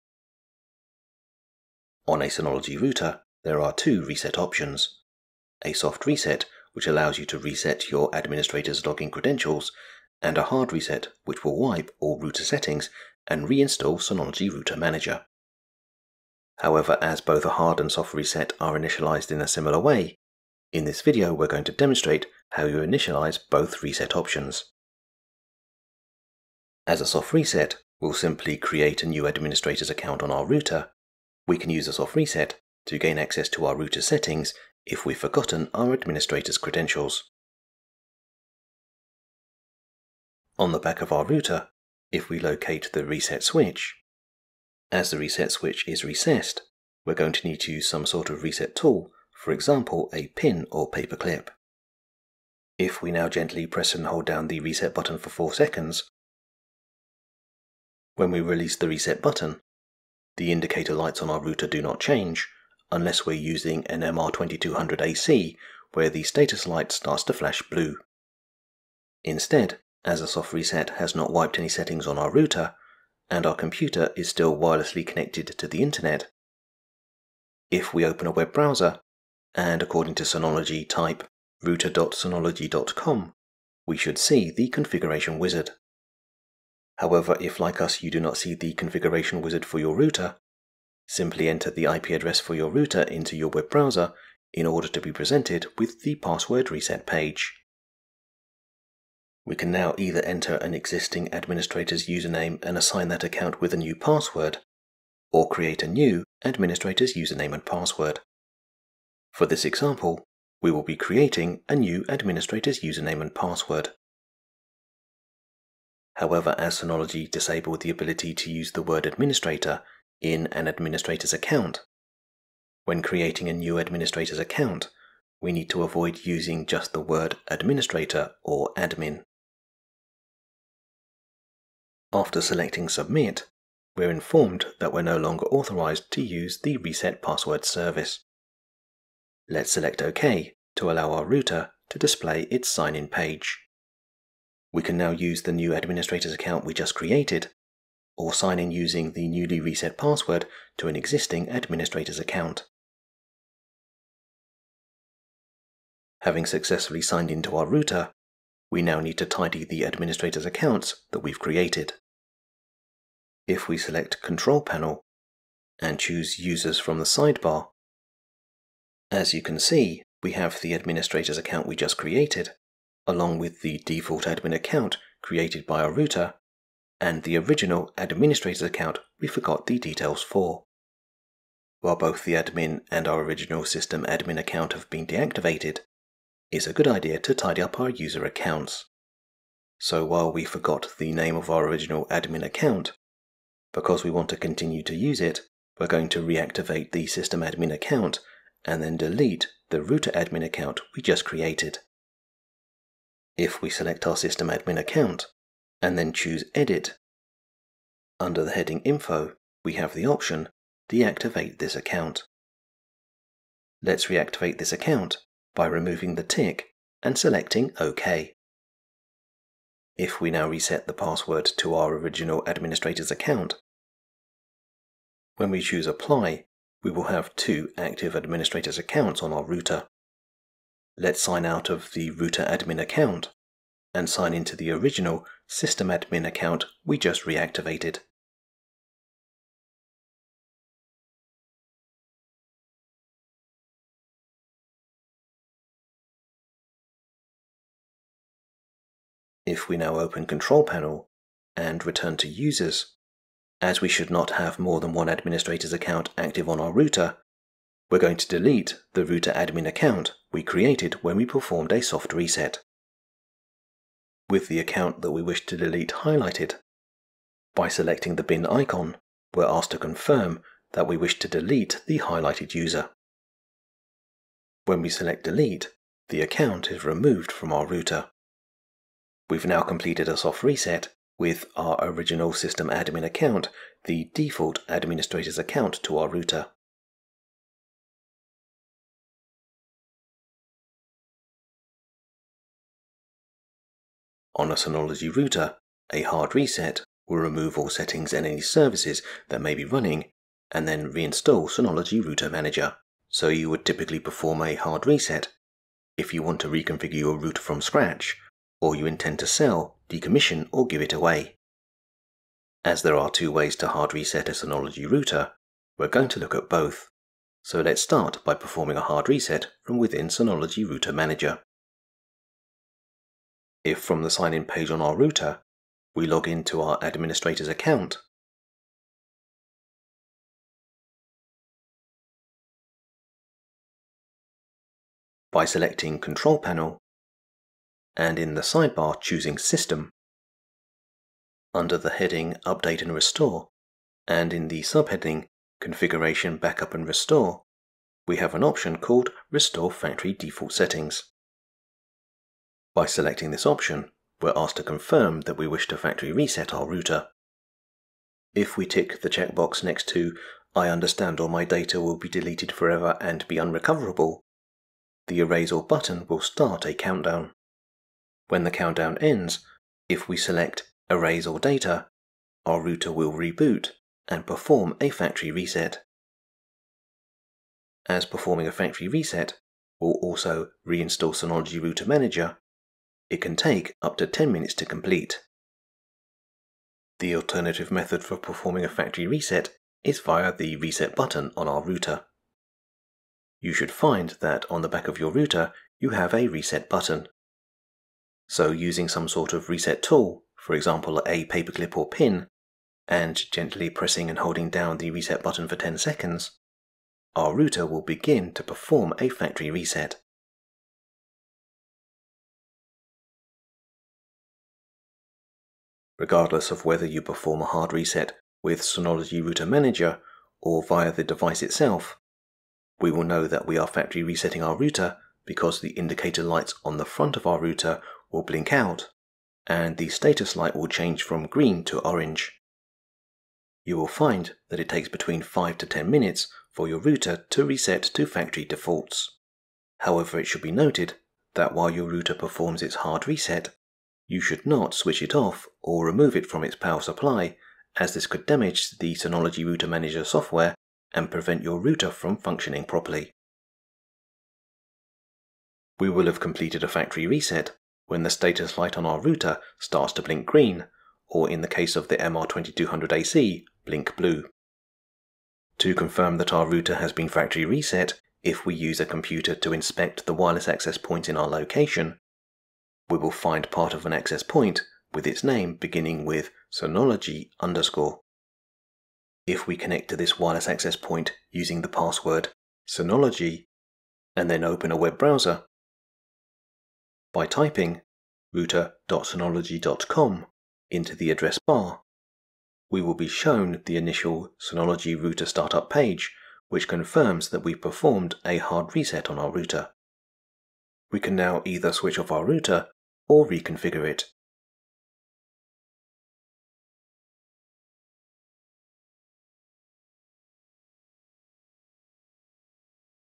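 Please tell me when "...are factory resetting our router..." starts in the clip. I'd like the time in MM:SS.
07:03.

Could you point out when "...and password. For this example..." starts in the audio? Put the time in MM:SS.
01:47.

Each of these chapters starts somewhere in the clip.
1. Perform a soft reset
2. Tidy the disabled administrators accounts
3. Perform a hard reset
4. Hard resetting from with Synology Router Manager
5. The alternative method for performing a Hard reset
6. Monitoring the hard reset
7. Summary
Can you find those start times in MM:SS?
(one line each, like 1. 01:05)
1. 00:39
2. 02:34
3. 04:54
4. 05:17
5. 06:27
6. 06:55
7. 07:45.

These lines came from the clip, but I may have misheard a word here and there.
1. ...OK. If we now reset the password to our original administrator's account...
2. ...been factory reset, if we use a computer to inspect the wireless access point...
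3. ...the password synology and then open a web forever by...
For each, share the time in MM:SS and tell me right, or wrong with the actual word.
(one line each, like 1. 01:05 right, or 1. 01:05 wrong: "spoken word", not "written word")
1. 03:37 right
2. 07:46 right
3. 08:01 wrong: "browser", not "forever".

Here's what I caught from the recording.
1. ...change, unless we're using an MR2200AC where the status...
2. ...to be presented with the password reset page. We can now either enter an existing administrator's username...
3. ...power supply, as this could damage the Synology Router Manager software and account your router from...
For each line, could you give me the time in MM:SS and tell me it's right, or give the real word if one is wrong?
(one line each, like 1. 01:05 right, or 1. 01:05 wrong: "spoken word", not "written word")
1. 01:01 right
2. 01:34 right
3. 07:26 wrong: "prevent", not "account".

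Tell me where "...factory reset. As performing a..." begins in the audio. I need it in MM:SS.
06:14.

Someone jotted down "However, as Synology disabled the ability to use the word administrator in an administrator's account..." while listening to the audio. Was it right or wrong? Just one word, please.
right.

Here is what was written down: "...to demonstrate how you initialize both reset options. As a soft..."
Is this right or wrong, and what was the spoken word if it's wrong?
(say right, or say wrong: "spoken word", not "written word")
right.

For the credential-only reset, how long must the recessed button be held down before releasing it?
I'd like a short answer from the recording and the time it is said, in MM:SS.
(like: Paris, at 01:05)
4 seconds, at 00:55.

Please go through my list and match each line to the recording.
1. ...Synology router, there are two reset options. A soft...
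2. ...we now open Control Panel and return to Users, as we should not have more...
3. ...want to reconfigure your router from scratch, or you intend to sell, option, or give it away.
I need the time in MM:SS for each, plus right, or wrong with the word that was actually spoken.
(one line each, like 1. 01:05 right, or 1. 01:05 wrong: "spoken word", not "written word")
1. 00:02 right
2. 04:09 right
3. 05:06 wrong: "decommission", not "option".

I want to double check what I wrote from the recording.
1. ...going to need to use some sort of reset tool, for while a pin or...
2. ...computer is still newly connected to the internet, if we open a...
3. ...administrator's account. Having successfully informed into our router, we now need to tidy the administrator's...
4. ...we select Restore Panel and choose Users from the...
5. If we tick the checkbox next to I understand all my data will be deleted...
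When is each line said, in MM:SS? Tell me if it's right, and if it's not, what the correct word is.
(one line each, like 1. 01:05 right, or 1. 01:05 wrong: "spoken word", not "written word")
1. 00:47 wrong: "example", not "while"
2. 01:13 wrong: "wirelessly", not "newly"
3. 02:31 wrong: "signed", not "informed"
4. 02:43 wrong: "Control", not "Restore"
5. 05:58 right.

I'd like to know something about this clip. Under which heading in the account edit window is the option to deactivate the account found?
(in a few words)
Info.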